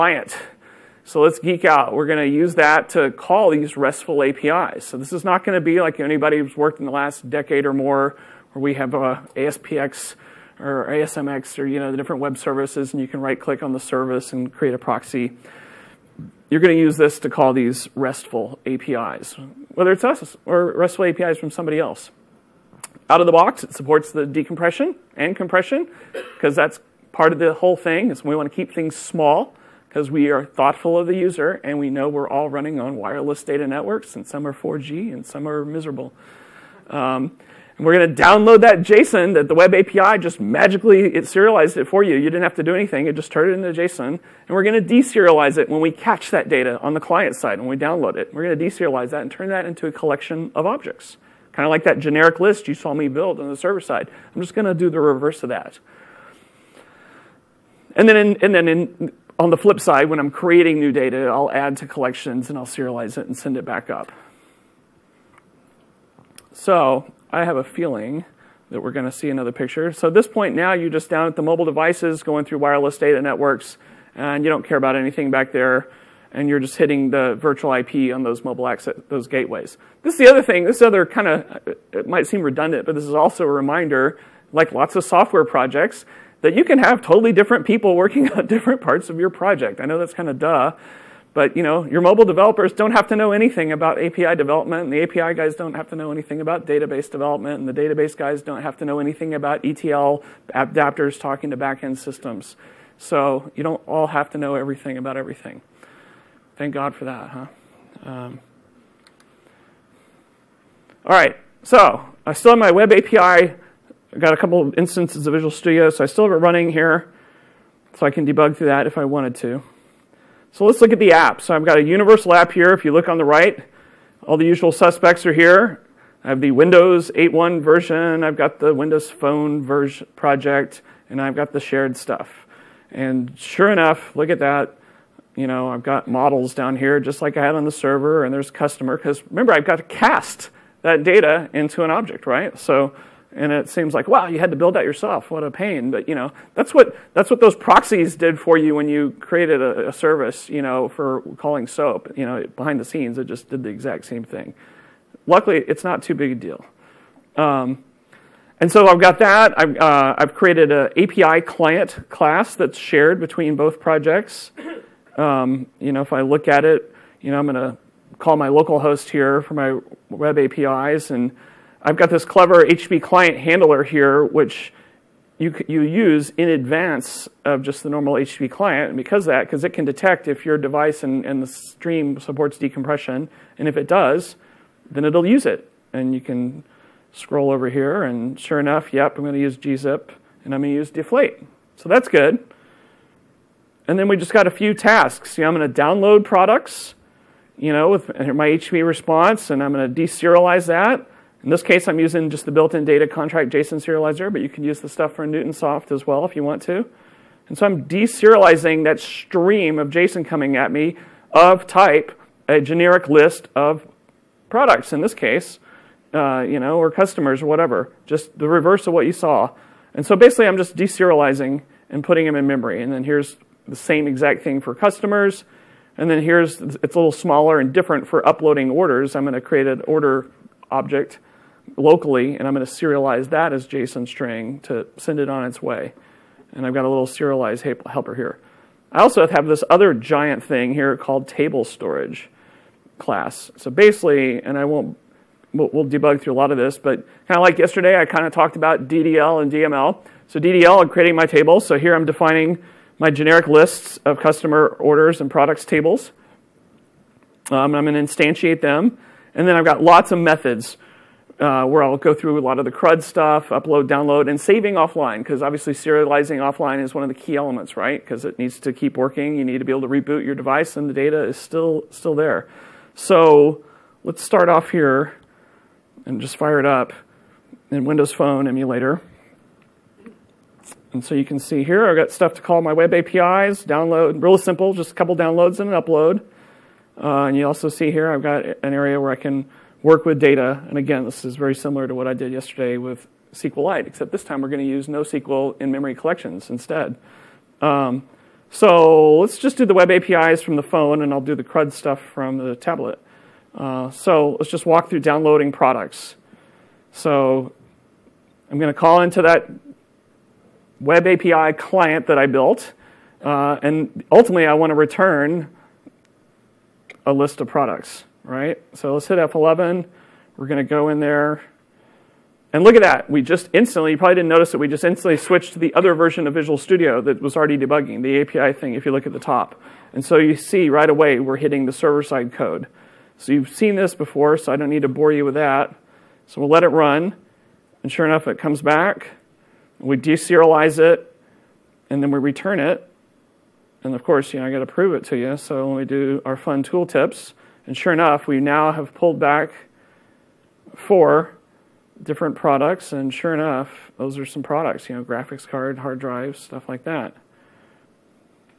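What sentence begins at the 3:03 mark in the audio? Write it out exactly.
And if it does, then it'll use it.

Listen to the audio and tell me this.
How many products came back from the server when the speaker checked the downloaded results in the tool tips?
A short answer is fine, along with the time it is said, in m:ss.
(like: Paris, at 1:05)
4, at 5:50.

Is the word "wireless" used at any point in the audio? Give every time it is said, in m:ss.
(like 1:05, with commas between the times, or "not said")
0:32, 1:12.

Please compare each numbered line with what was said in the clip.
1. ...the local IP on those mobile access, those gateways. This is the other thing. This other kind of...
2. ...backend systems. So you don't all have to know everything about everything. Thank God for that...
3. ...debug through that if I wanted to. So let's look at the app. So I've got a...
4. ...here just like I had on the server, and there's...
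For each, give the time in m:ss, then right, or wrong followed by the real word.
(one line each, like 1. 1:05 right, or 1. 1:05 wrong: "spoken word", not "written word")
1. 1:17 wrong: "virtual", not "local"
2. 1:41 right
3. 1:58 right
4. 2:16 right.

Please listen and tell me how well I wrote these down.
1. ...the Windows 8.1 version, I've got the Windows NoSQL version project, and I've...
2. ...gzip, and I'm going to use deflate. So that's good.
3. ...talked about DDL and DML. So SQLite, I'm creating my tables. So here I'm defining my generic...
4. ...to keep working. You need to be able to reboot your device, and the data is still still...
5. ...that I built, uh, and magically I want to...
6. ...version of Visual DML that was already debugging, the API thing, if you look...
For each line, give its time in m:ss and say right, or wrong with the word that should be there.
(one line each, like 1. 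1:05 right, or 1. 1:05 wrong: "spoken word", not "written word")
1. 2:06 wrong: "Phone", not "NoSQL"
2. 3:09 right
3. 4:08 wrong: "DDL", not "SQLite"
4. 4:28 right
5. 5:12 wrong: "ultimately", not "magically"
6. 5:25 wrong: "Studio", not "DML".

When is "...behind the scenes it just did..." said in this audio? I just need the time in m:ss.
2:32.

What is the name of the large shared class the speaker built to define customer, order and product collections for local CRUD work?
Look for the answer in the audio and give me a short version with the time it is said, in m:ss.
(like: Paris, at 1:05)
table storage class, at 4:01.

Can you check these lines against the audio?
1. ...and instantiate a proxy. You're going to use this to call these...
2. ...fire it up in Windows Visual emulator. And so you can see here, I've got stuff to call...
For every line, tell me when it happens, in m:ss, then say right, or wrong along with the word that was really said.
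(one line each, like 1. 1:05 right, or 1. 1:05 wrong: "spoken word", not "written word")
1. 0:14 wrong: "create", not "instantiate"
2. 4:36 wrong: "Phone", not "Visual".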